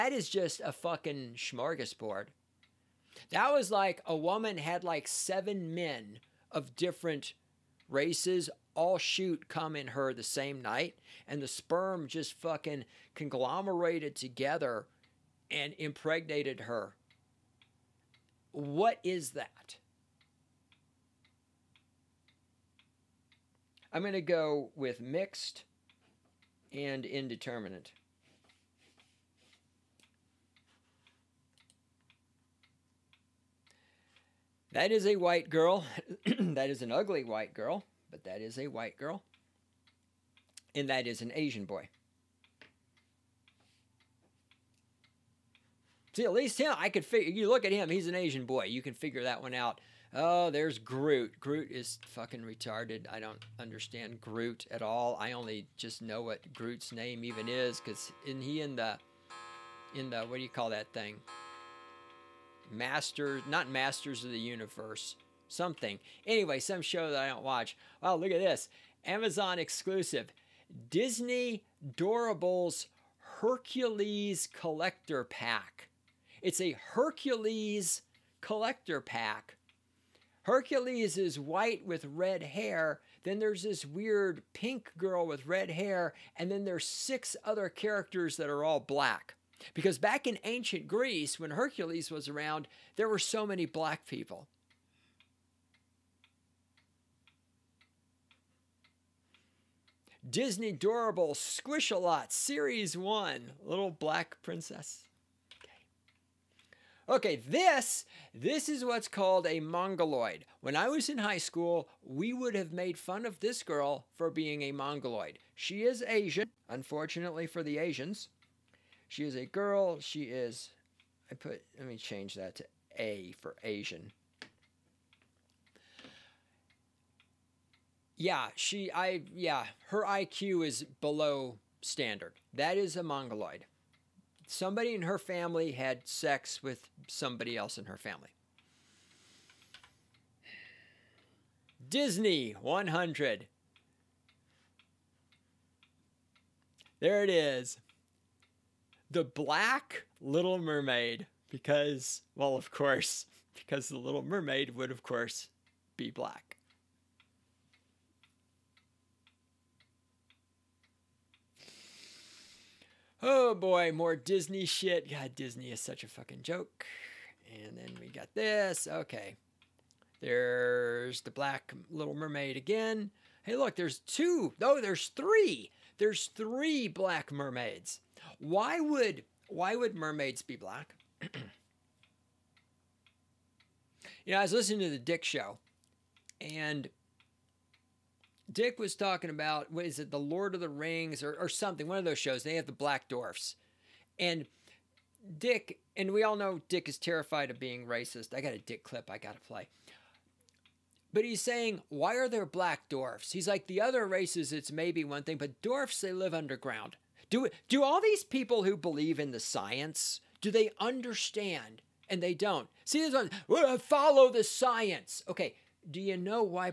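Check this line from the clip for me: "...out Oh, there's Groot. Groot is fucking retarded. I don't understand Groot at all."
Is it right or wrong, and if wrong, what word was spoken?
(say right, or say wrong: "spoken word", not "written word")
right.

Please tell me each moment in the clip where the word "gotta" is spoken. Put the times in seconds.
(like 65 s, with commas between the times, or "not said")
199 s.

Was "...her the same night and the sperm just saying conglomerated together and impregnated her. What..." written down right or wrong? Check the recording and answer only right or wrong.
wrong.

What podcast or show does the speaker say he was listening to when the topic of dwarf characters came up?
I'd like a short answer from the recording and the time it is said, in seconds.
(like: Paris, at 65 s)
The Dick Show, at 184 s.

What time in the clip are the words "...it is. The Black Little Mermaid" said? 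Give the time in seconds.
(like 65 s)
147 s.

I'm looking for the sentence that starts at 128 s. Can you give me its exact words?
Yeah, she, I, yeah, her IQ is below standard.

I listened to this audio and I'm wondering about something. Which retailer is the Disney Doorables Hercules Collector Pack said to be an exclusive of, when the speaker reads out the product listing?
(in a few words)
Amazon.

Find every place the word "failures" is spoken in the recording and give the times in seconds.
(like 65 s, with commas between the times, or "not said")
not said.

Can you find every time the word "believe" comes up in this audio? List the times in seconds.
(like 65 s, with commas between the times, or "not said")
208 s.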